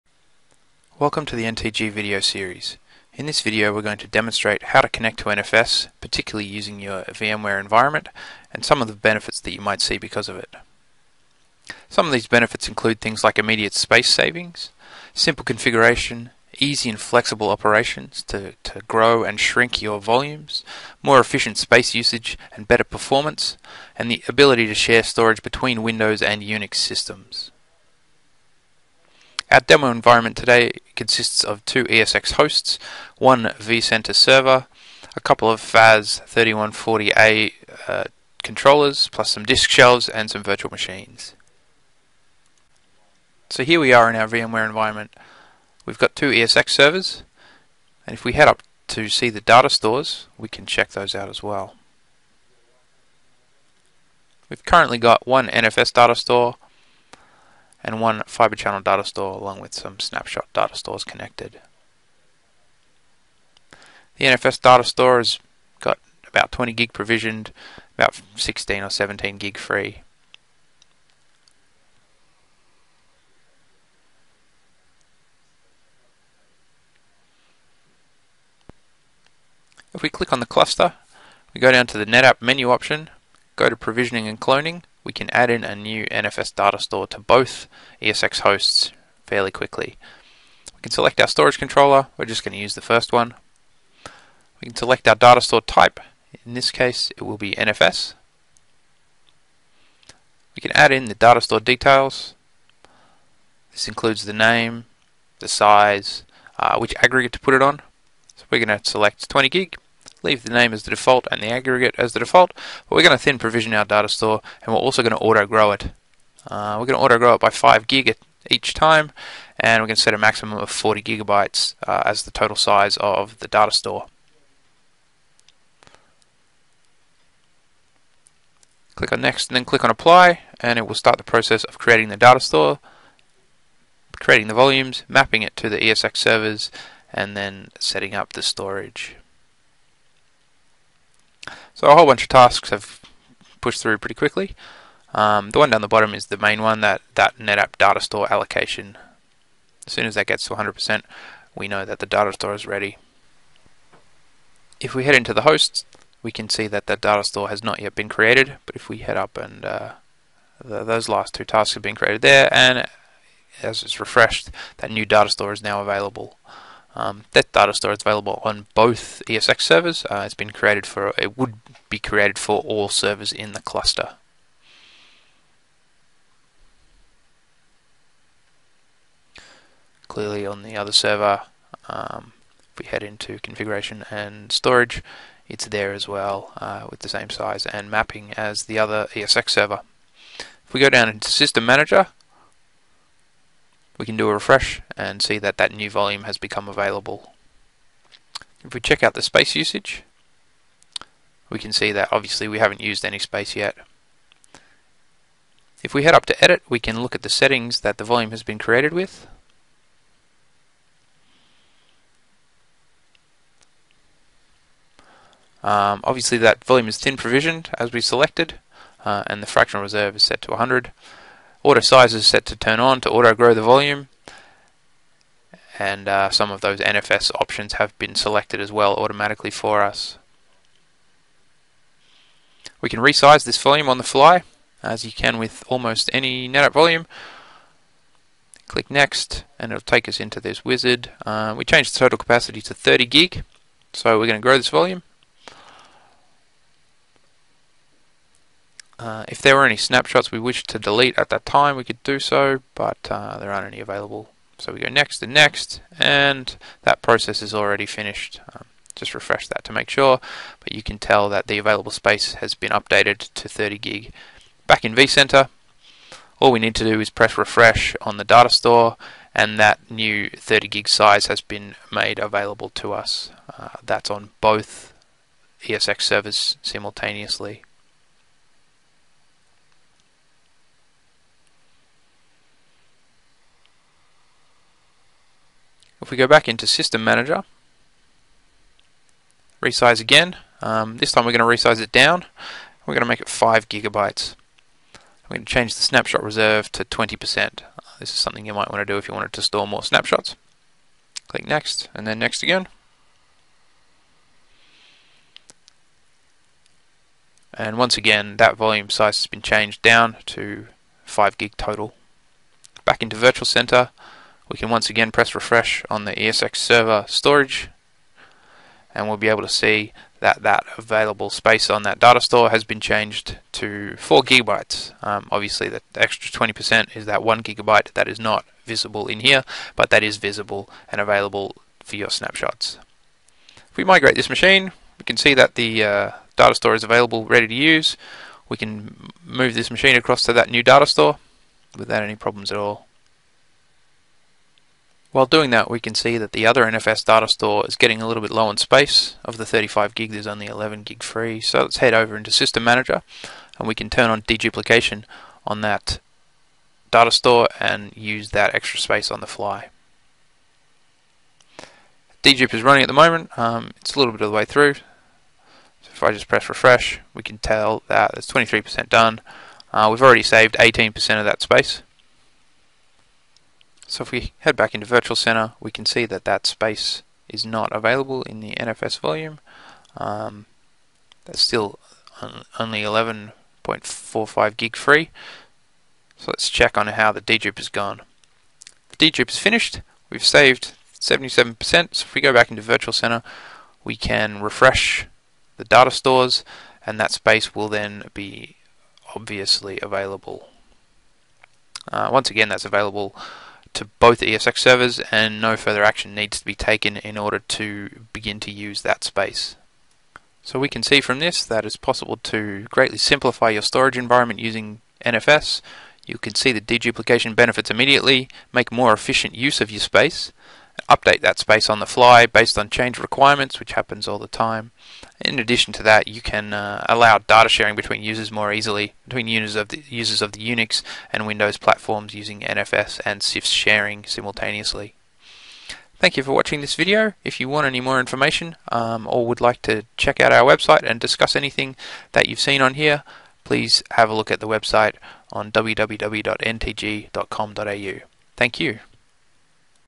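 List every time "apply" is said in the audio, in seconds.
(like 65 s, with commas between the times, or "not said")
129 s.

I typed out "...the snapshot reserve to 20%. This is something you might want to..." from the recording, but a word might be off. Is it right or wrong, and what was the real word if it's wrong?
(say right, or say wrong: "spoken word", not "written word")
right.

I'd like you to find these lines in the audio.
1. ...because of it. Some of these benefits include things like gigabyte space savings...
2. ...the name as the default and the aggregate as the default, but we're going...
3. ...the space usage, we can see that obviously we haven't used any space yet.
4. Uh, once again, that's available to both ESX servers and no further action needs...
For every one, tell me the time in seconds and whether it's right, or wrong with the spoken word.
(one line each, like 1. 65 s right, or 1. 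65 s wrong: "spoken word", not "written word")
1. 9 s wrong: "immediate", not "gigabyte"
2. 110 s right
3. 199 s right
4. 401 s right.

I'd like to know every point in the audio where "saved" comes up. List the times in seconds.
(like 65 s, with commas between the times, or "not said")
370 s, 390 s.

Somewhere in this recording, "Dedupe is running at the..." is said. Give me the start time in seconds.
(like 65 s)
362 s.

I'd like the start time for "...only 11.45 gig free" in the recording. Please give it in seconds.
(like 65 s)
382 s.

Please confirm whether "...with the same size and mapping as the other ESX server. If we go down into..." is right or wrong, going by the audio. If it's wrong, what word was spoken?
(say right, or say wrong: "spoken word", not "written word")
right.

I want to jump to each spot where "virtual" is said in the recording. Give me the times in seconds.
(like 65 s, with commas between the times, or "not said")
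40 s, 313 s, 374 s, 392 s.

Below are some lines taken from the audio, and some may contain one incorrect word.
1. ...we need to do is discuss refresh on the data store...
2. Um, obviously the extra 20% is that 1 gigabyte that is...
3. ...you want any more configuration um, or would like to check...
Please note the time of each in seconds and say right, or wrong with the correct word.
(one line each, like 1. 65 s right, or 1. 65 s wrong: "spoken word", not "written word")
1. 266 s wrong: "press", not "discuss"
2. 325 s right
3. 437 s wrong: "information", not "configuration".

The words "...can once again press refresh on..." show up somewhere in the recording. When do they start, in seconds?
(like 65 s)
314 s.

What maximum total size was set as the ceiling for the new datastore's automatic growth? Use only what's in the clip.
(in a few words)
40 gigabytes.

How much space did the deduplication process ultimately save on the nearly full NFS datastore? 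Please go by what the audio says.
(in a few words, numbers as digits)
77%.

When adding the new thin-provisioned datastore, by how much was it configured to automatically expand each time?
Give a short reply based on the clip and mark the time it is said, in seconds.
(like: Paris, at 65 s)
5 gig, at 117 s.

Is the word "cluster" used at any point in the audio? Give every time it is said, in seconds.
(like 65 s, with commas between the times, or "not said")
80 s, 173 s.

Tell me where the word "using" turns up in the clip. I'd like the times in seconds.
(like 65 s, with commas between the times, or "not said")
6 s, 414 s, 432 s.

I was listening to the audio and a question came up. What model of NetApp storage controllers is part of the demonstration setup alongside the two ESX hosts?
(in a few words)
FAS 3140A.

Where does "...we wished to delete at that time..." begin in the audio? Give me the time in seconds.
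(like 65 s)
250 s.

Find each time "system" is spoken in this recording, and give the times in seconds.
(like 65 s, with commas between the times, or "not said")
26 s, 191 s, 286 s, 352 s.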